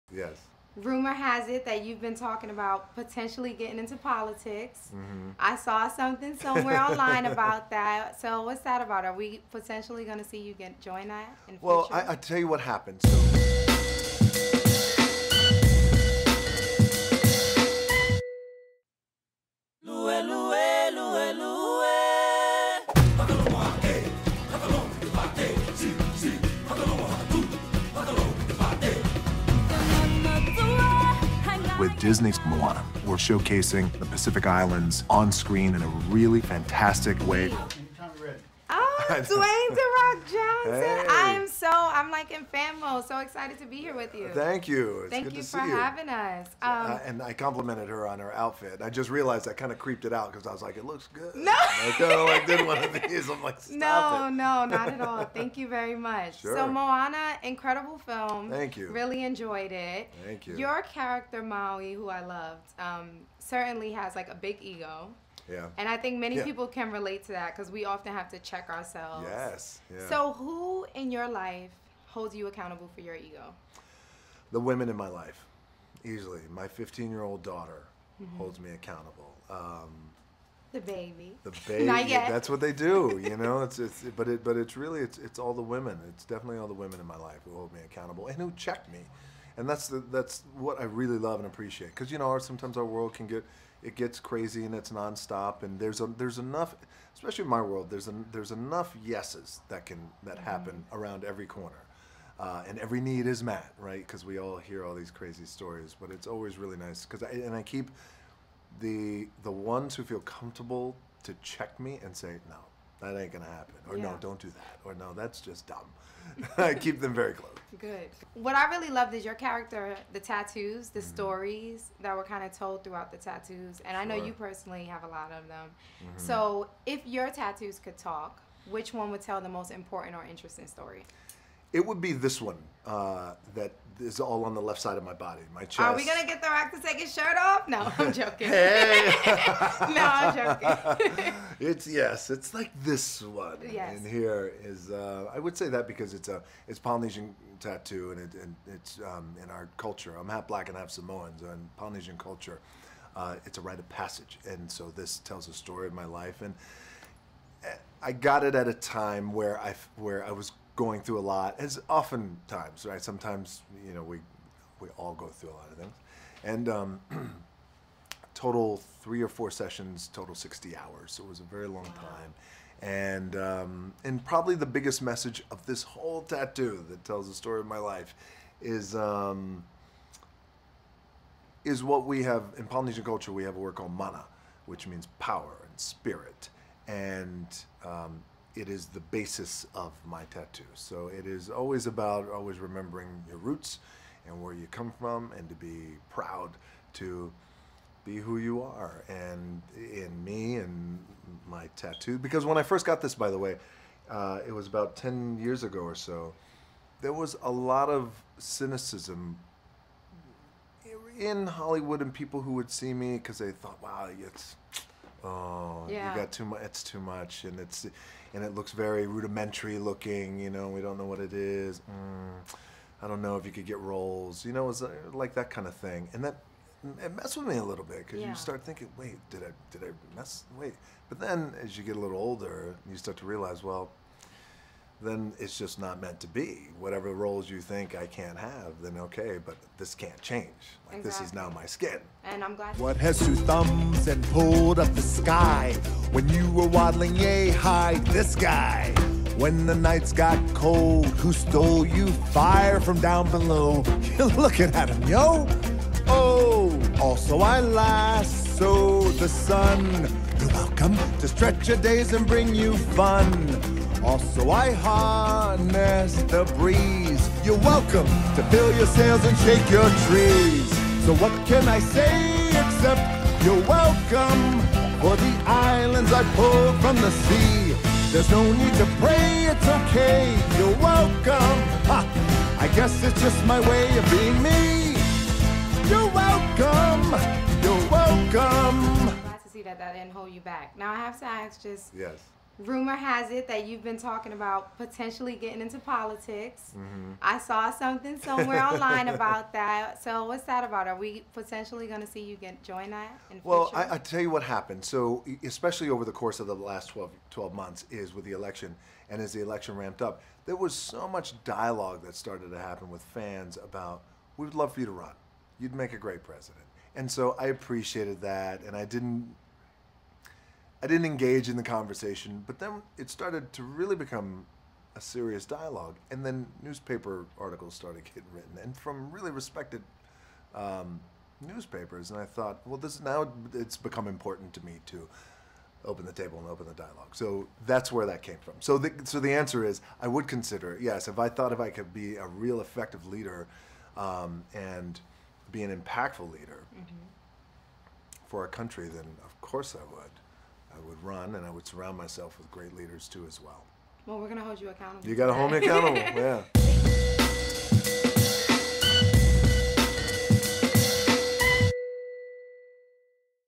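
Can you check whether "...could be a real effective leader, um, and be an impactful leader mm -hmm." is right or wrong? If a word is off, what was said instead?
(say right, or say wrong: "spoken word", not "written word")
right.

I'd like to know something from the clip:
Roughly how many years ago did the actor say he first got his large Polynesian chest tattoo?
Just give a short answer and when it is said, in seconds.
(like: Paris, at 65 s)
10 years, at 204 s.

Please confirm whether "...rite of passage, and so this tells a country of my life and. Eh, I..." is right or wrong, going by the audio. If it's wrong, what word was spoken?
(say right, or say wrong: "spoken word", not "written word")
wrong: "story", not "country".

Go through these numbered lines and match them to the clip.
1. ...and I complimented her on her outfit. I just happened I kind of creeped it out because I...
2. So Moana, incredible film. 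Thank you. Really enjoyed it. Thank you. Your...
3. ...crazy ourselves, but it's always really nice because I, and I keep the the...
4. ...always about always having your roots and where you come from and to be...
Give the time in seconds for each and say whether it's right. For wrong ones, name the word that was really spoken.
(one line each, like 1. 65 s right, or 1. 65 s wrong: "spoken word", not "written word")
1. 47 s wrong: "realized", not "happened"
2. 56 s right
3. 105 s wrong: "stories", not "ourselves"
4. 191 s wrong: "remembering", not "having".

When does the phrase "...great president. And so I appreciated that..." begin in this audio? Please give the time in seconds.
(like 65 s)
315 s.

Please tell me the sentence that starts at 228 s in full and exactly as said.
you start thinking, wait, did I did I mess?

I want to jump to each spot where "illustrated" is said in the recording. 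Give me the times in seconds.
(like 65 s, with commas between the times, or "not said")
not said.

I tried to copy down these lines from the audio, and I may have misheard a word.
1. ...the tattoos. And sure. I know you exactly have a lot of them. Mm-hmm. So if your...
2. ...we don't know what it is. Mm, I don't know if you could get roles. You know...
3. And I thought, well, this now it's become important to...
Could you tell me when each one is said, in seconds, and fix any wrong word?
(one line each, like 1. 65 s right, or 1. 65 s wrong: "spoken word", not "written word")
1. 123 s wrong: "personally", not "exactly"
2. 220 s right
3. 332 s right.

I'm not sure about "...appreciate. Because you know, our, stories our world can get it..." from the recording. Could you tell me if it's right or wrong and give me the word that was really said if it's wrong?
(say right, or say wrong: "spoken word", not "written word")
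wrong: "sometimes", not "stories".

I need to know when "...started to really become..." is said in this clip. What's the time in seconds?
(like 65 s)
323 s.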